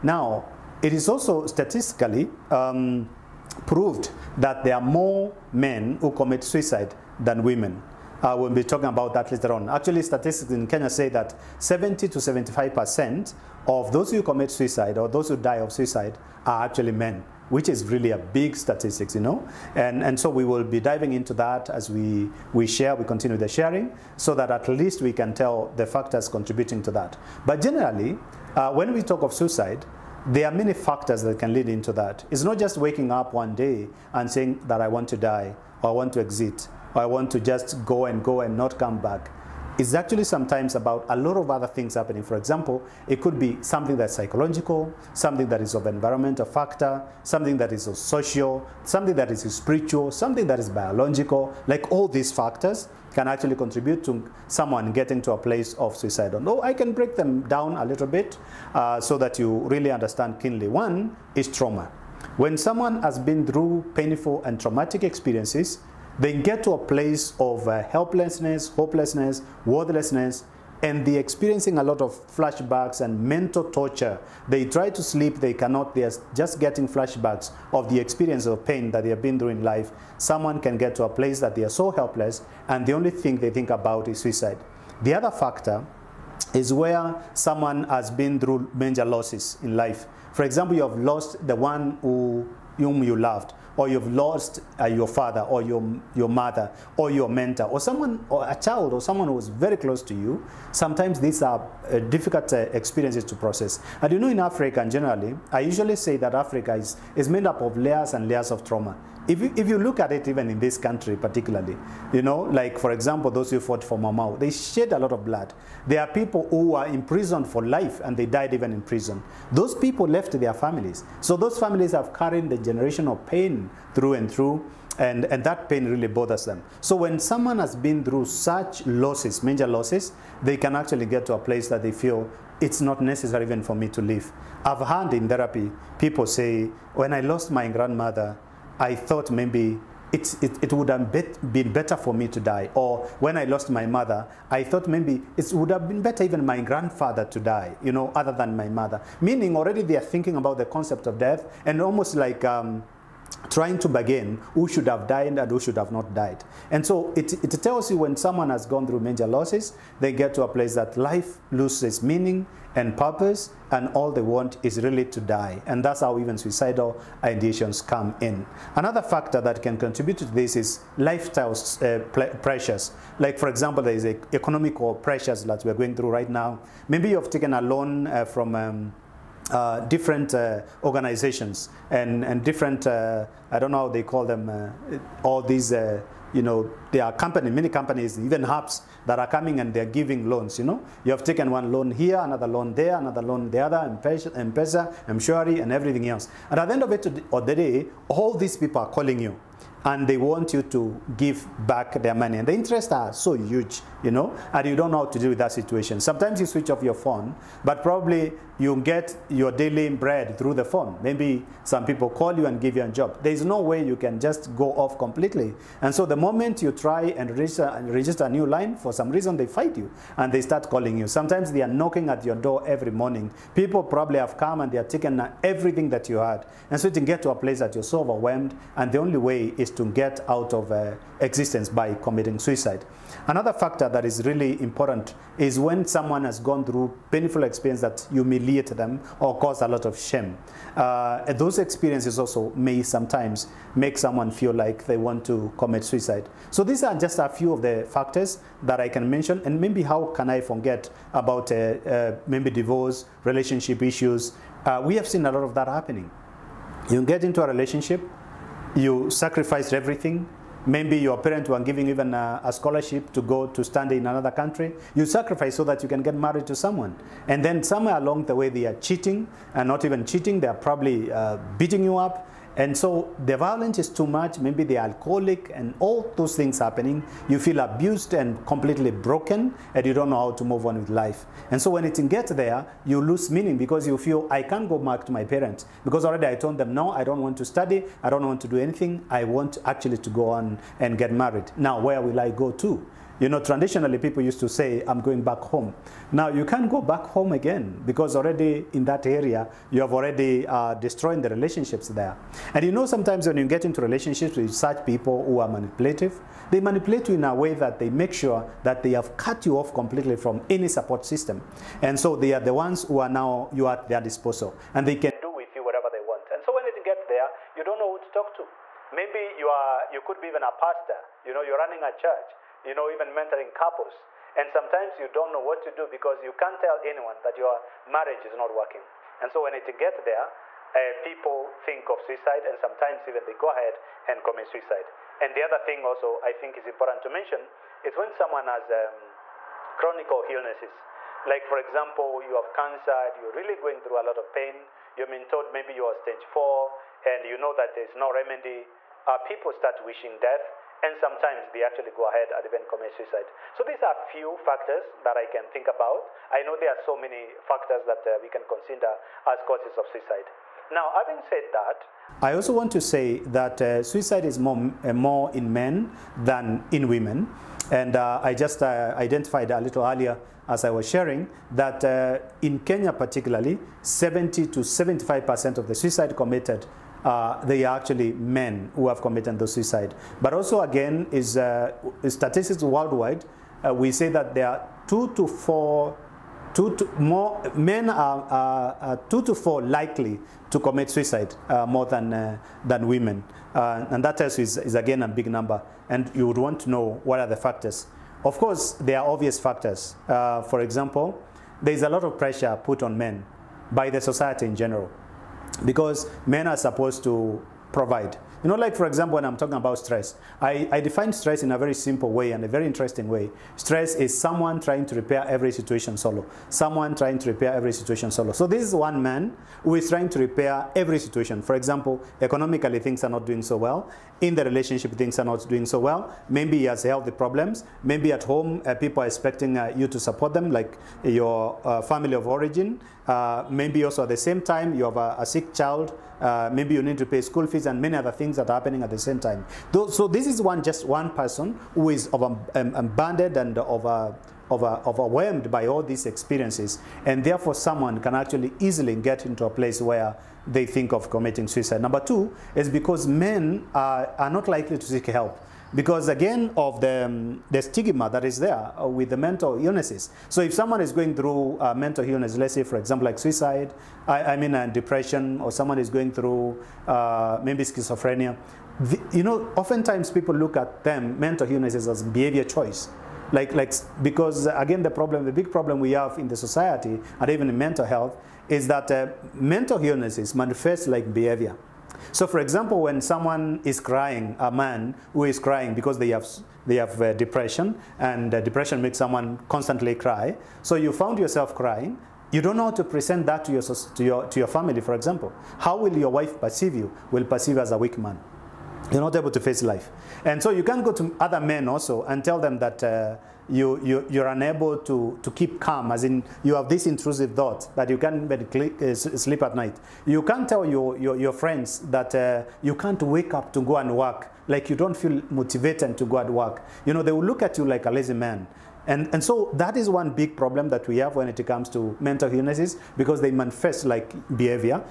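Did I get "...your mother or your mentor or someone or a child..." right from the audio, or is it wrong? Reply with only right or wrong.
right.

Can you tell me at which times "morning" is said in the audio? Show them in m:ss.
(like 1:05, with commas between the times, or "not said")
3:42.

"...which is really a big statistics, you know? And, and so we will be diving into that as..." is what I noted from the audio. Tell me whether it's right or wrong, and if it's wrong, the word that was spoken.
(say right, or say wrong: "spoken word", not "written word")
right.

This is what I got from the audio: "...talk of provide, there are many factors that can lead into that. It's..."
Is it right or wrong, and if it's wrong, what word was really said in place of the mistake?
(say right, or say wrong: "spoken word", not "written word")
wrong: "suicide", not "provide".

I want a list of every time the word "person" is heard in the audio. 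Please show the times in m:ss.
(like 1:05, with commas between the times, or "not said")
7:21.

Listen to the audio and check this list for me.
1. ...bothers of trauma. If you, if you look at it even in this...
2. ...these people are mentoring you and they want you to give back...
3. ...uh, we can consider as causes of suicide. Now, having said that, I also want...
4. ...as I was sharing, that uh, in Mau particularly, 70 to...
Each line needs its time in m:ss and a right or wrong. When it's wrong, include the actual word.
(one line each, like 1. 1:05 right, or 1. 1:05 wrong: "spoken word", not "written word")
1. 1:48 wrong: "layers", not "bothers"
2. 3:18 wrong: "calling", not "mentoring"
3. 5:58 right
4. 6:10 wrong: "Kenya", not "Mau".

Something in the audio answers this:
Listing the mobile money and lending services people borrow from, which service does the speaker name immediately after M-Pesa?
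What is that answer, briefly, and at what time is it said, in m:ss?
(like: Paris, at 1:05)
M-Shwari, at 3:15.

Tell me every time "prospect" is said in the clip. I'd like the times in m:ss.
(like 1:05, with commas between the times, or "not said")
not said.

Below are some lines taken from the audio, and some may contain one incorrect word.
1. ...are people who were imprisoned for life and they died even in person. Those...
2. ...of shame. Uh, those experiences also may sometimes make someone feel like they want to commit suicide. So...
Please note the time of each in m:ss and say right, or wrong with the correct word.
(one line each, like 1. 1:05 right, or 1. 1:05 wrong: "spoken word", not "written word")
1. 1:56 wrong: "prison", not "person"
2. 3:59 right.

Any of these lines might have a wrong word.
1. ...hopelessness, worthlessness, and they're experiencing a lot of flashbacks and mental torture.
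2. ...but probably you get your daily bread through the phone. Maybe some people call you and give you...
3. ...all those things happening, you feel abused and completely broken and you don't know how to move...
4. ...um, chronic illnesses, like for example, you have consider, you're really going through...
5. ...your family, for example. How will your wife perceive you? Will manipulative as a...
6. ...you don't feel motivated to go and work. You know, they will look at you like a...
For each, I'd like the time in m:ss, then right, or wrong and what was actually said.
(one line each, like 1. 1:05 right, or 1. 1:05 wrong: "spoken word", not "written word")
1. 1:08 right
2. 3:27 right
3. 4:35 right
4. 5:38 wrong: "cancer", not "consider"
5. 8:14 wrong: "perceive", not "manipulative"
6. 8:34 right.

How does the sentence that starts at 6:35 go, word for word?
And you would want to know what are the factors.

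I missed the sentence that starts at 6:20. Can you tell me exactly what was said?
But also, again, is uh, statistics worldwide.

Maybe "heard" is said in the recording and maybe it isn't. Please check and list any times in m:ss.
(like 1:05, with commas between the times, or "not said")
2:14.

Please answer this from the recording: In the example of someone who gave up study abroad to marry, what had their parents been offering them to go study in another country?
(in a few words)
A scholarship.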